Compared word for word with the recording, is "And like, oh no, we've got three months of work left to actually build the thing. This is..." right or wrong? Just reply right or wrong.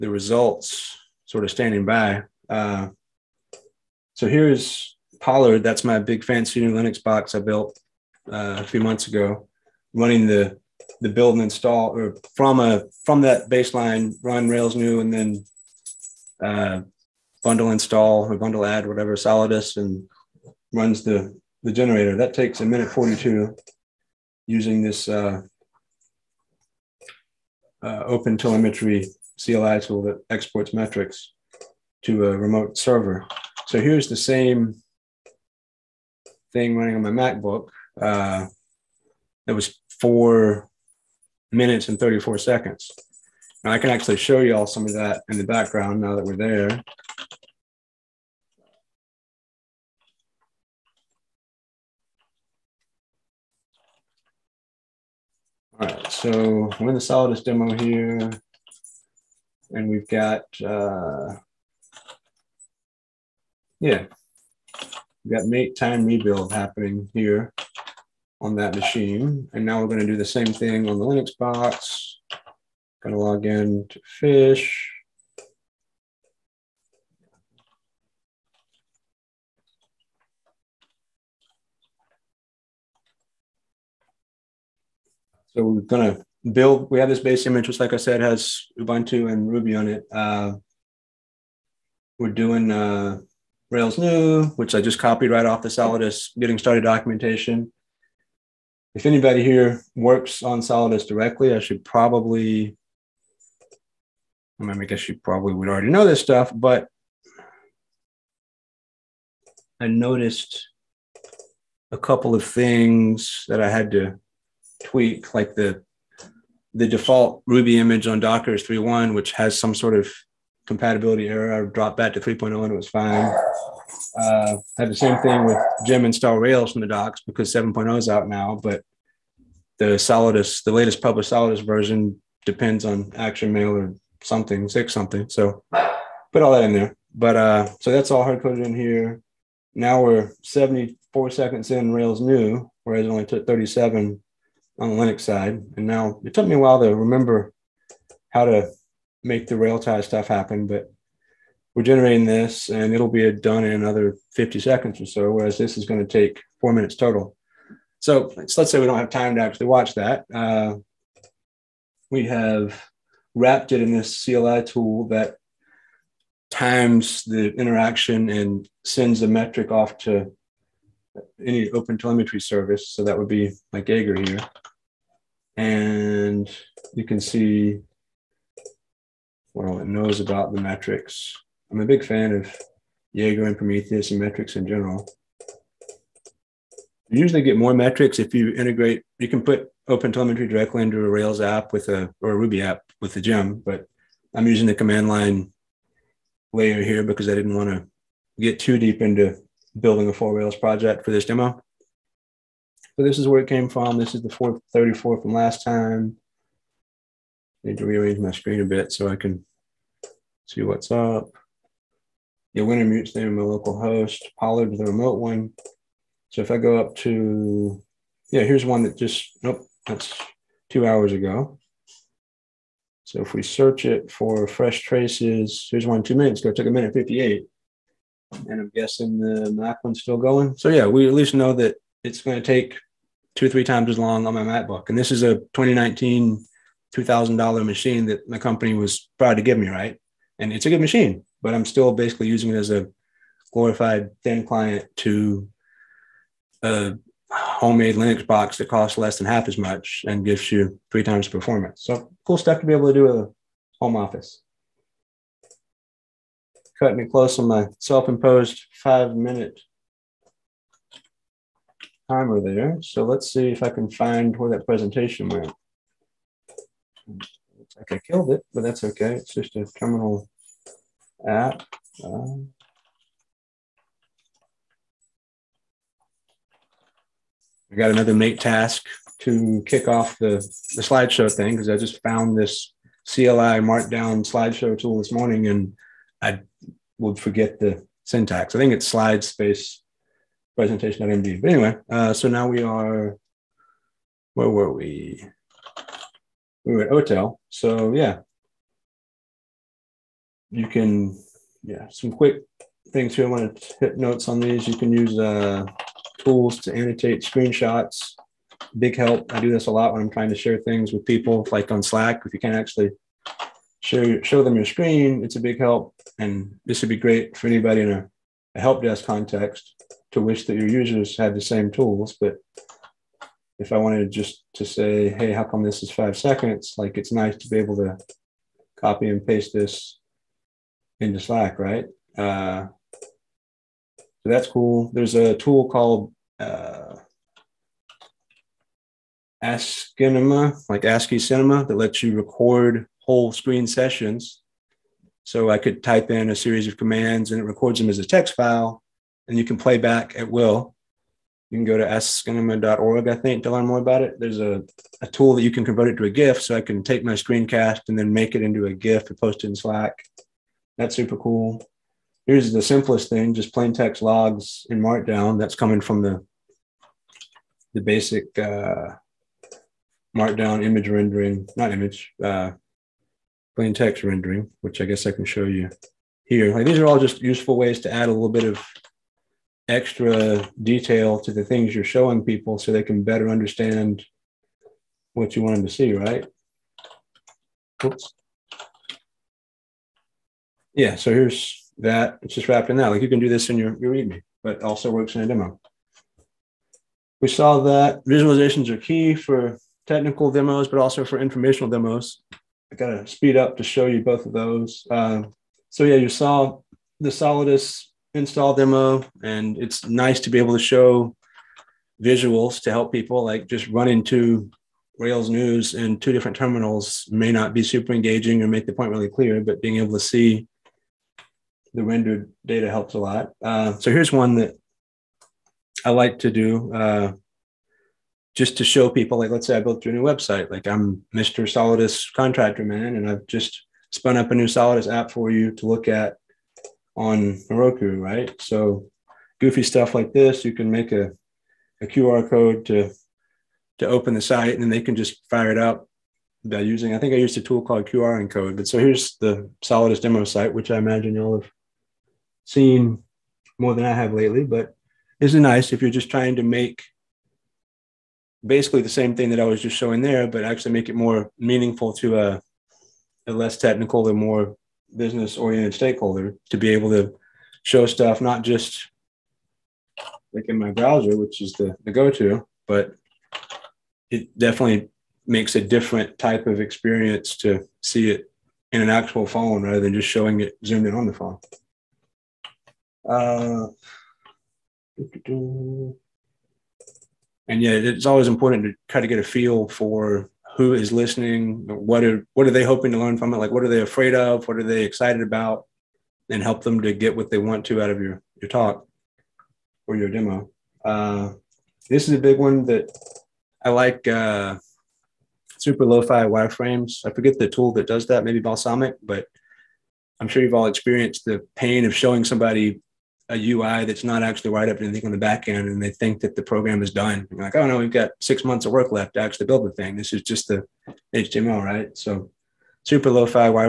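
wrong.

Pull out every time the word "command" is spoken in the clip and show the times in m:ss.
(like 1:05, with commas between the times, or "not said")
3:14, 5:46.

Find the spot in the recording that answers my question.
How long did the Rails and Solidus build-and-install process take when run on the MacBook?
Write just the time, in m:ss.
0:39.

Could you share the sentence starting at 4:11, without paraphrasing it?
So cool stuff to be able to do a home office.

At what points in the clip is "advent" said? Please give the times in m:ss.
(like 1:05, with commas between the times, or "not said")
not said.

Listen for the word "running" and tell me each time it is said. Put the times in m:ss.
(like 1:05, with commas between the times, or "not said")
0:09, 0:36.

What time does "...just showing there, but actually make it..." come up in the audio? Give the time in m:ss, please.
7:39.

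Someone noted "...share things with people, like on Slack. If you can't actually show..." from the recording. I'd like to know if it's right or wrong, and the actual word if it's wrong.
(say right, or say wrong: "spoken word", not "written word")
right.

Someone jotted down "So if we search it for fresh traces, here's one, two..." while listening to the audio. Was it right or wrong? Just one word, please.
right.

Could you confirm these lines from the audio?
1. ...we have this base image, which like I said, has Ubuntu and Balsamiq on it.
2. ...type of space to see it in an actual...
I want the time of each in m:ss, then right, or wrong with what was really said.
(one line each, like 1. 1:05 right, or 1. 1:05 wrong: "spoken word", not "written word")
1. 1:26 wrong: "Ruby", not "Balsamiq"
2. 7:56 wrong: "experience", not "space".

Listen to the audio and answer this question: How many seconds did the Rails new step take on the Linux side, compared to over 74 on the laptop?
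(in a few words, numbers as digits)
37.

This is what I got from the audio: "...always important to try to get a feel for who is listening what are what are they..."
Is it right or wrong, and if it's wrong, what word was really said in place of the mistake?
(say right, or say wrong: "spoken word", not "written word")
right.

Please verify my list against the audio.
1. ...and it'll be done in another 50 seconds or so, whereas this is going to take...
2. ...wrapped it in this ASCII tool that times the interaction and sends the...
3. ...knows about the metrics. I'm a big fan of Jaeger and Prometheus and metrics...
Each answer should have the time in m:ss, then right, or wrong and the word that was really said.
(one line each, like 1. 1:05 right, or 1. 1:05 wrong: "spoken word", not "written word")
1. 2:32 right
2. 2:43 wrong: "CLI", not "ASCII"
3. 2:59 right.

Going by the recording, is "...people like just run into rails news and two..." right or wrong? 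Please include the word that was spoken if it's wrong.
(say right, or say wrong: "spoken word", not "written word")
right.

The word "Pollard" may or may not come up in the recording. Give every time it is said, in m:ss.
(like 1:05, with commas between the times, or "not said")
0:05, 3:34.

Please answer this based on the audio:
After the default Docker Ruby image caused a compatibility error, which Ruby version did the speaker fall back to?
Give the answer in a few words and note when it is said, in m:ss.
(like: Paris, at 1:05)
3.0, at 2:02.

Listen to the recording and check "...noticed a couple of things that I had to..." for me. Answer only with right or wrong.
right.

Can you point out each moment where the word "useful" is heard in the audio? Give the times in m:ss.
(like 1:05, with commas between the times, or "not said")
6:17.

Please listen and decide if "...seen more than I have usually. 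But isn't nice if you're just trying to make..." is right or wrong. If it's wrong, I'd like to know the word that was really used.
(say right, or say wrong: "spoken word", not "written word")
wrong: "lately", not "usually".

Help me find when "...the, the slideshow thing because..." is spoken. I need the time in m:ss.
4:40.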